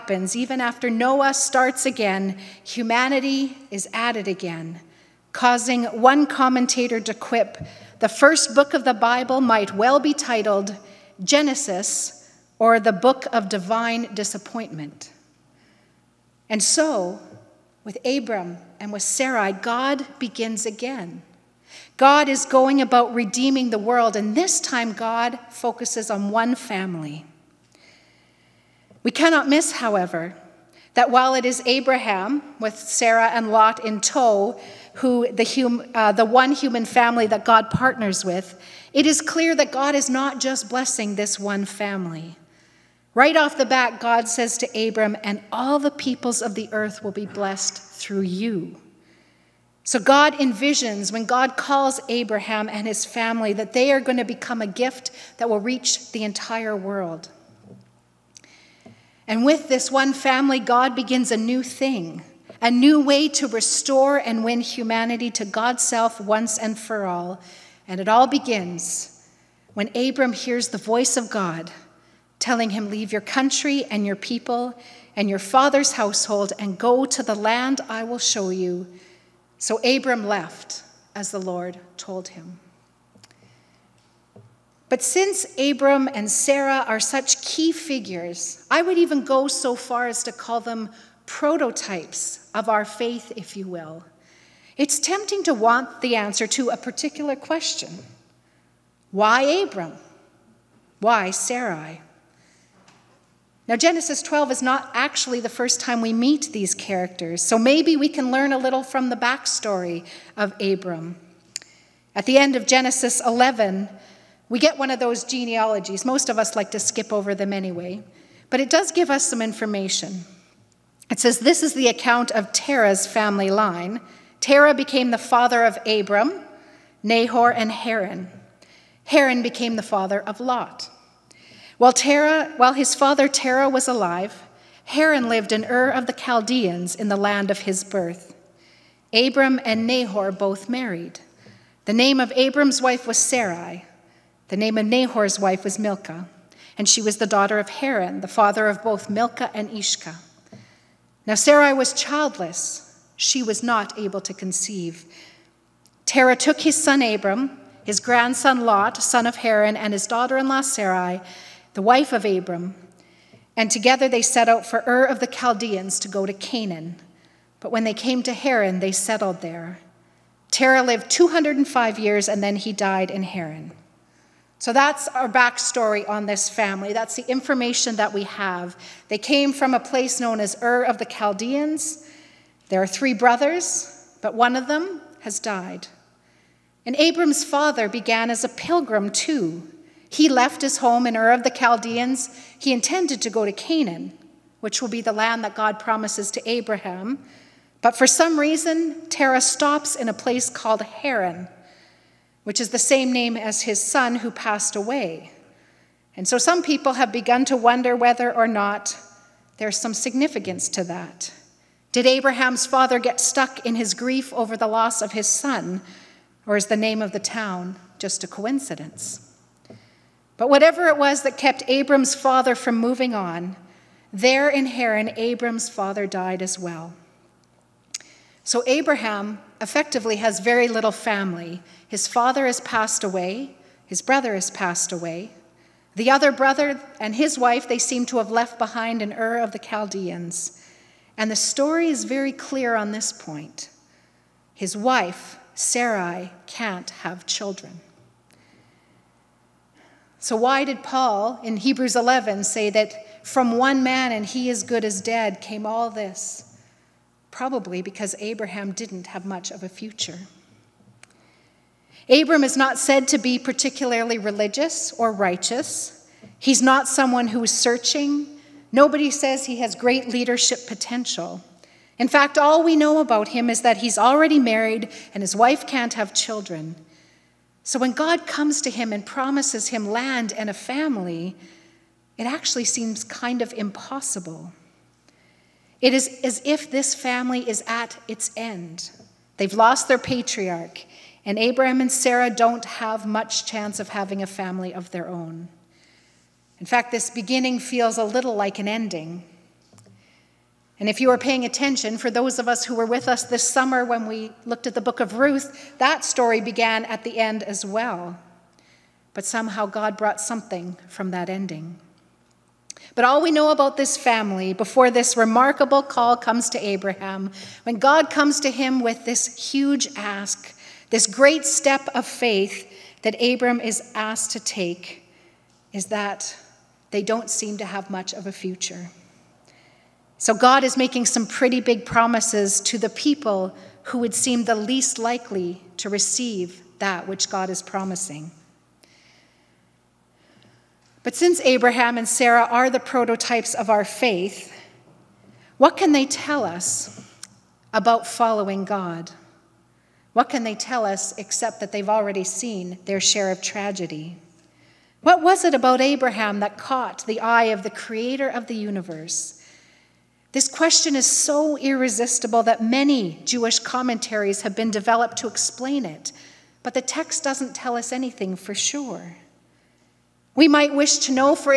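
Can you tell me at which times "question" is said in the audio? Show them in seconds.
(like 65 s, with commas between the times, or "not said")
97 s, 360 s.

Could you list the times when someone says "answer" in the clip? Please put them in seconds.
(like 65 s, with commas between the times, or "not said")
96 s.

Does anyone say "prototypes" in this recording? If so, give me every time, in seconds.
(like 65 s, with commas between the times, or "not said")
91 s, 342 s.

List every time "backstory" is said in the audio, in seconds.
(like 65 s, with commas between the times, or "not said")
109 s, 175 s.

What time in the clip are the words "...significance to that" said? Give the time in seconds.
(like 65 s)
209 s.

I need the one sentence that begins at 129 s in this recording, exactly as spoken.
Haran became the father of Lot.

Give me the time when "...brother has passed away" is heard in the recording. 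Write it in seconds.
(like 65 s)
234 s.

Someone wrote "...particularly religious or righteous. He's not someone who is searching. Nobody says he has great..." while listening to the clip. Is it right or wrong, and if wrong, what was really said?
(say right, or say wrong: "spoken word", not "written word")
right.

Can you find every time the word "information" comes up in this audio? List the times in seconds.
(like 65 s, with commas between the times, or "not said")
119 s, 177 s.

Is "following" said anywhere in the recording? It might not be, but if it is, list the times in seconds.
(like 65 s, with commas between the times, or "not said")
348 s.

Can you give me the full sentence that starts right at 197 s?
But for some reason, Terah stops in a place called Haran which is the same name as his son who passed away.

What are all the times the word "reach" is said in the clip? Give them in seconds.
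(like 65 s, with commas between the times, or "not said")
55 s.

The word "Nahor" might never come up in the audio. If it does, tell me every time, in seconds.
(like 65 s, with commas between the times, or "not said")
127 s, 139 s, 144 s.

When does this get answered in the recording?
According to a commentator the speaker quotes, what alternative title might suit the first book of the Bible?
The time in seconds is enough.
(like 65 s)
12 s.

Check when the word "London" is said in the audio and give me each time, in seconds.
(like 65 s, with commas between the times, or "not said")
not said.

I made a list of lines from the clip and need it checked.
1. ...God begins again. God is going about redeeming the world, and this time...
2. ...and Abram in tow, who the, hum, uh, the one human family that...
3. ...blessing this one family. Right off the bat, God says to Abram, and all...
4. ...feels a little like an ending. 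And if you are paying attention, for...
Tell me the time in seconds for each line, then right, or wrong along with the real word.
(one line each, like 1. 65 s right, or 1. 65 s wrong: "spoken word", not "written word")
1. 19 s right
2. 33 s wrong: "Lot", not "Abram"
3. 40 s right
4. 297 s right.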